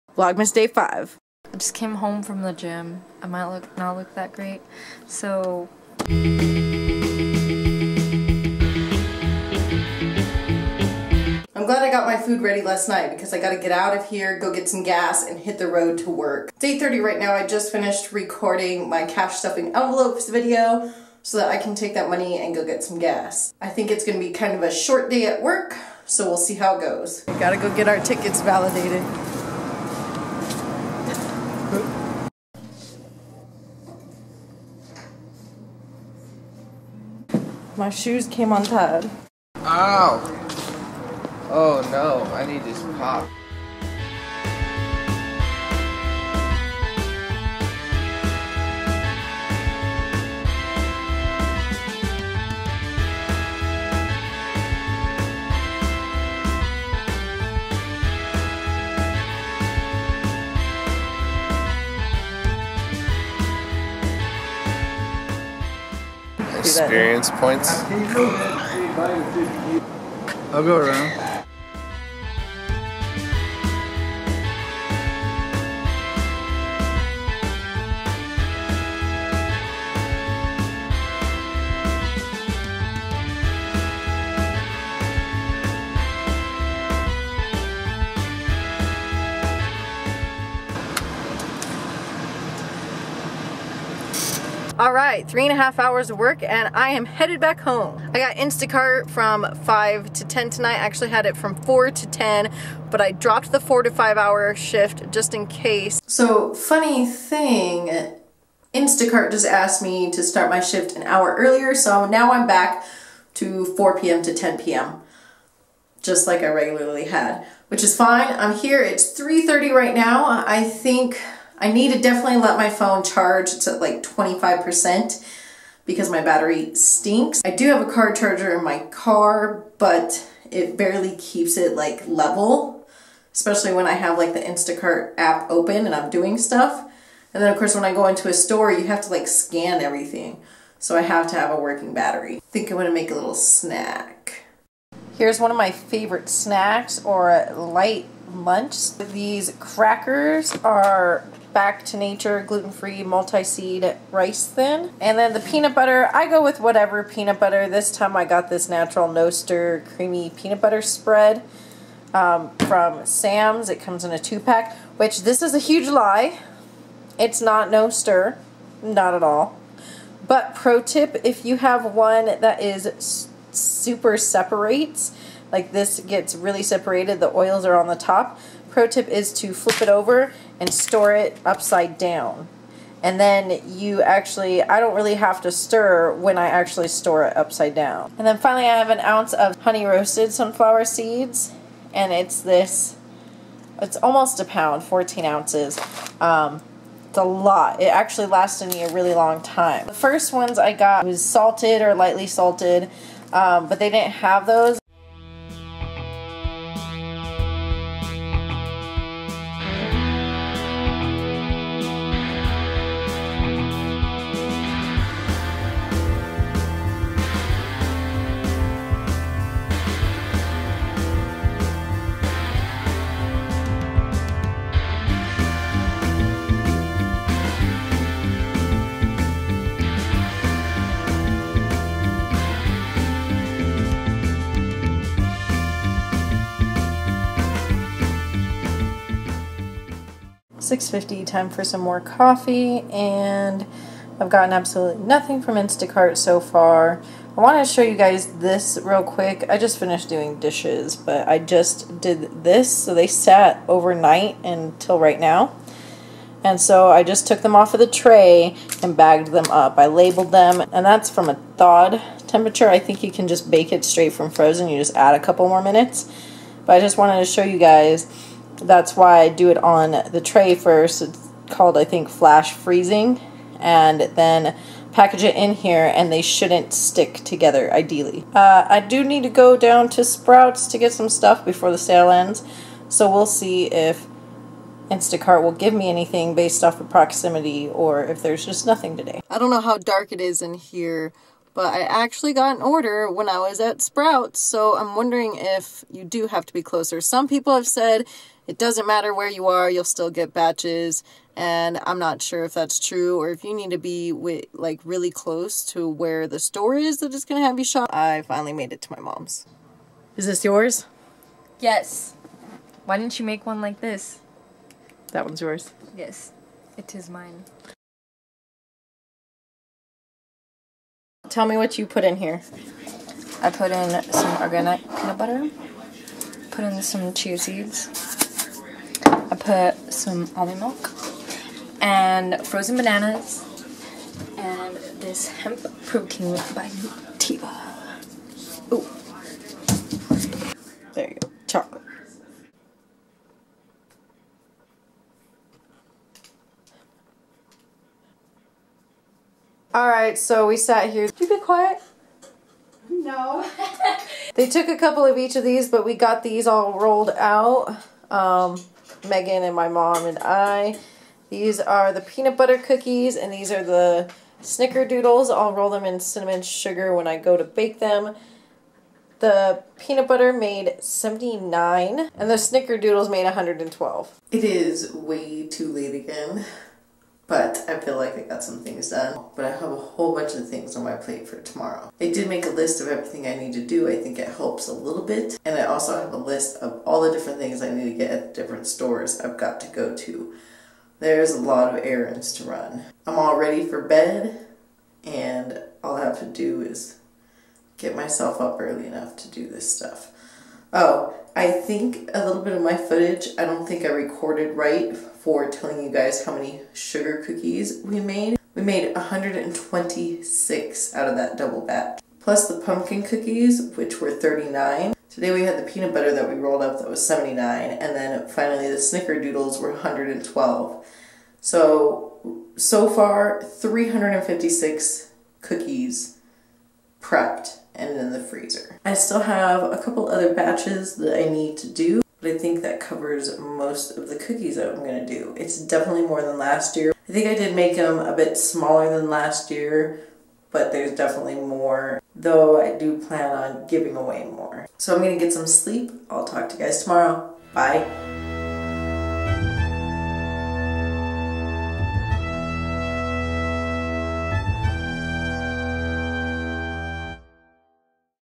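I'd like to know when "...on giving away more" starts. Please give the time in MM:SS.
07:23.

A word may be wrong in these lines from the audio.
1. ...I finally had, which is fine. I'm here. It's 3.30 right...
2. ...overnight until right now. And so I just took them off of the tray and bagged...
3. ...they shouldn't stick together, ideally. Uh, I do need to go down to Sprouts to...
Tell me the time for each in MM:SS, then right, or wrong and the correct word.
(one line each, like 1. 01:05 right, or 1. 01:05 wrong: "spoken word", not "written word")
1. 01:56 wrong: "regularly", not "finally"
2. 04:13 right
3. 04:36 right.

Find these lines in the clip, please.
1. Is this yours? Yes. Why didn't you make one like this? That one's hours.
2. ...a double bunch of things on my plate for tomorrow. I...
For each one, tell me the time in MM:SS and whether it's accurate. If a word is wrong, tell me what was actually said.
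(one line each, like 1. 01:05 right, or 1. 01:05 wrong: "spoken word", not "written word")
1. 05:10 wrong: "yours", not "hours"
2. 06:19 wrong: "whole", not "double".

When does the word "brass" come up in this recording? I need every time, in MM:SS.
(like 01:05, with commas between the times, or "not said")
not said.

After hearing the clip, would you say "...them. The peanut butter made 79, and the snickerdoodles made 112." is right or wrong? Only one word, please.
right.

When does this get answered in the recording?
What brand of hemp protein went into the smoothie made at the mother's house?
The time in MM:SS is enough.
05:36.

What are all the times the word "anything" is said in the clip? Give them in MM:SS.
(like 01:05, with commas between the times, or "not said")
04:45.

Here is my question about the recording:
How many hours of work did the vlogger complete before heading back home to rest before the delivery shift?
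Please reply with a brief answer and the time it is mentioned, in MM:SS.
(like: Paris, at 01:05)
3.5, at 01:35.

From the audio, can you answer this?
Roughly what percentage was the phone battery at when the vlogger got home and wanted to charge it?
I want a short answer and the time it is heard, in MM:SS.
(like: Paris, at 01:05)
25%, at 02:04.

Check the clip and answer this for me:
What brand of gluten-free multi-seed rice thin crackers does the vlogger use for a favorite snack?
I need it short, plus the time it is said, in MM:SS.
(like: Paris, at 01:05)
Back to Nature, at 02:31.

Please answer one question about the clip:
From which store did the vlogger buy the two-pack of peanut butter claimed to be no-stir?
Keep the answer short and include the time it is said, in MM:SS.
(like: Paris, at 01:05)
Sam's, at 02:43.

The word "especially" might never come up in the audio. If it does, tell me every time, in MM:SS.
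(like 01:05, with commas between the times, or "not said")
02:13.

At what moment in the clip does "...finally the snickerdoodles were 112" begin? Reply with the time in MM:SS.
06:58.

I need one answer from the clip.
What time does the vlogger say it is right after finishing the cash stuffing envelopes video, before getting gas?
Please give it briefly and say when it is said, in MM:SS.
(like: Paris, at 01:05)
8:30, at 00:16.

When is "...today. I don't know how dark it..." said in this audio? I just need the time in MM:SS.
04:48.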